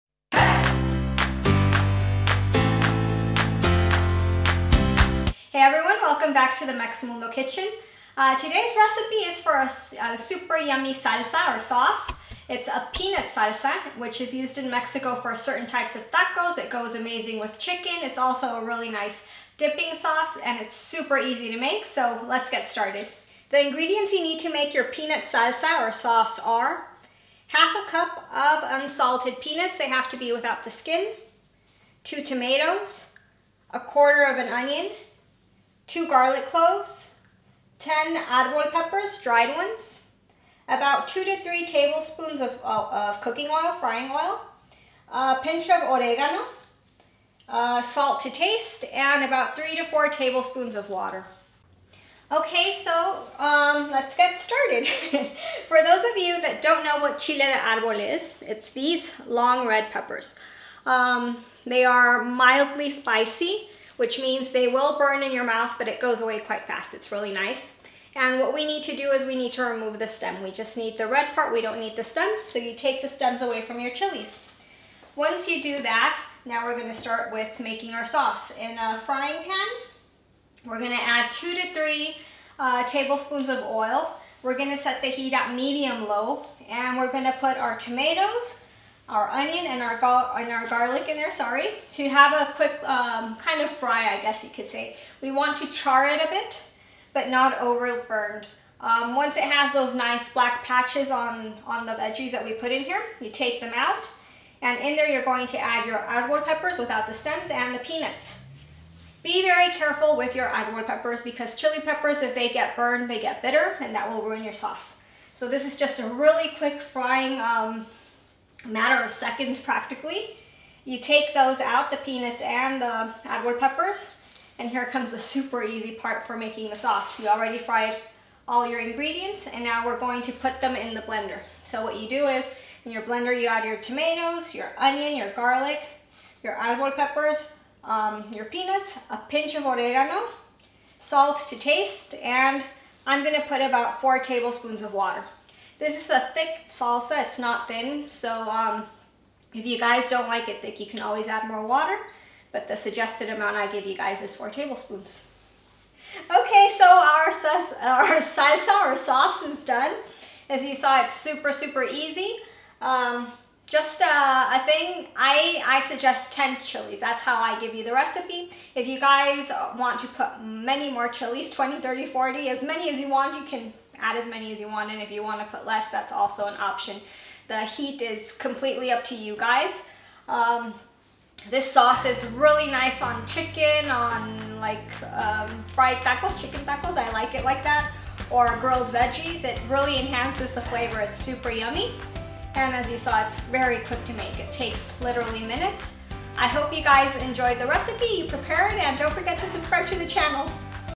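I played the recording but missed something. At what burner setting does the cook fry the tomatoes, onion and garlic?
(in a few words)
medium low.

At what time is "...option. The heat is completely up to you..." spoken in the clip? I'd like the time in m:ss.
2:56.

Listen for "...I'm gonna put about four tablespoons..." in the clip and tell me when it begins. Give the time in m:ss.
2:23.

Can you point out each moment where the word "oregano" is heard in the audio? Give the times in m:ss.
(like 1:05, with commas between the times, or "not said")
0:45, 2:19.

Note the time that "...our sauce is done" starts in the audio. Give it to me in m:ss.
2:38.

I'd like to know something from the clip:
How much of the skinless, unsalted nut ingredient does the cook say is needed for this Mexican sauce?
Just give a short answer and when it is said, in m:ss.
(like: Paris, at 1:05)
half a cup, at 0:27.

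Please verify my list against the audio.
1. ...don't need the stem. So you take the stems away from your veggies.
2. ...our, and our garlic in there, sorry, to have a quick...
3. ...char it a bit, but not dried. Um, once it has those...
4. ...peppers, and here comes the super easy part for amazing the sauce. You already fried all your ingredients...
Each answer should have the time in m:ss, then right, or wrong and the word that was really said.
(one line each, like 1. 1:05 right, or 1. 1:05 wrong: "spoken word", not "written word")
1. 1:11 wrong: "chilies", not "veggies"
2. 1:29 right
3. 1:35 wrong: "overburned", not "dried"
4. 2:03 wrong: "making", not "amazing".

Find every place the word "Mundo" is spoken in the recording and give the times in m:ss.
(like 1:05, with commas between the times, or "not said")
0:07.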